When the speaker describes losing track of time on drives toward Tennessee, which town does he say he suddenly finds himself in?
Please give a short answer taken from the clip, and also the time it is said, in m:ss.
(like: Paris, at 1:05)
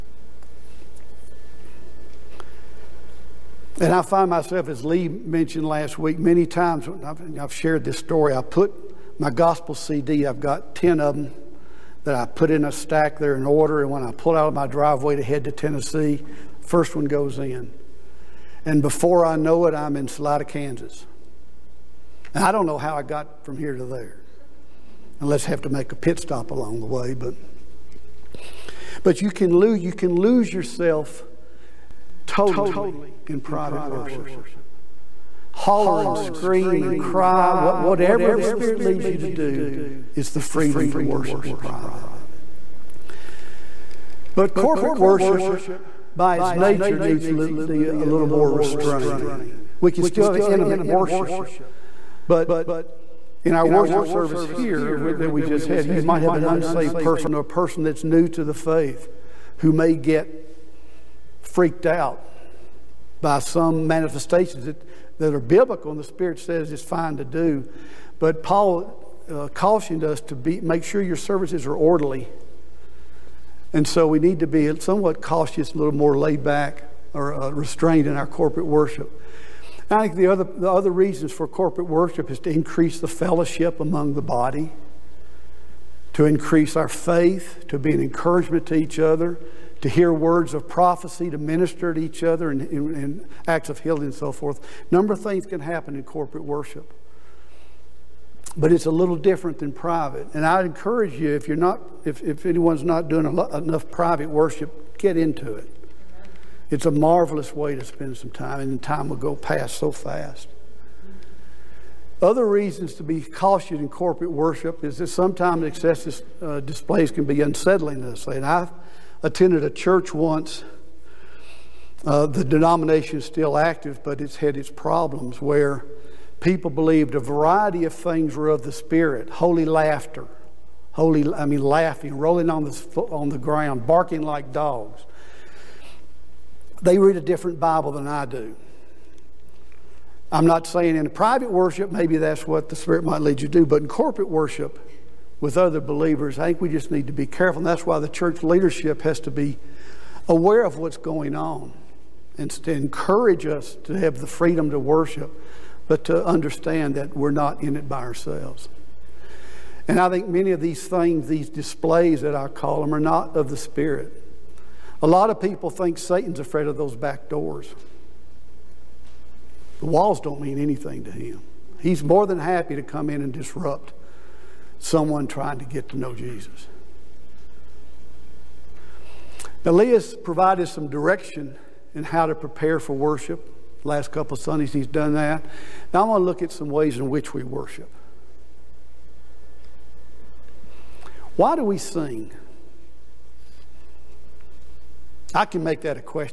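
Salina, Kansas, at 0:20.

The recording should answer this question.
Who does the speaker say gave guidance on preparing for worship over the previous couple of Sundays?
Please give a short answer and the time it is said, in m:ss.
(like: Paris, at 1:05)
Elias, at 2:59.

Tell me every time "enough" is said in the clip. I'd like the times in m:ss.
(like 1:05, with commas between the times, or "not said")
1:43.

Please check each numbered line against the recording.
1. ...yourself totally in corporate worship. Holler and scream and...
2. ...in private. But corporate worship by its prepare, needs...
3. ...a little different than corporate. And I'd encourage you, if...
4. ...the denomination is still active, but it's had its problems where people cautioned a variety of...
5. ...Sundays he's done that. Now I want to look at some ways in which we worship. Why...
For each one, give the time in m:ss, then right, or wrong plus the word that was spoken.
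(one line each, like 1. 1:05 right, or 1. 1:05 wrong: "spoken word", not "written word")
1. 0:30 wrong: "private", not "corporate"
2. 0:41 wrong: "nature", not "prepare"
3. 1:38 wrong: "private", not "corporate"
4. 2:02 wrong: "believed", not "cautioned"
5. 3:04 right.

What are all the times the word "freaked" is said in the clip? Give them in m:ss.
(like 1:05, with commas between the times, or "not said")
1:01.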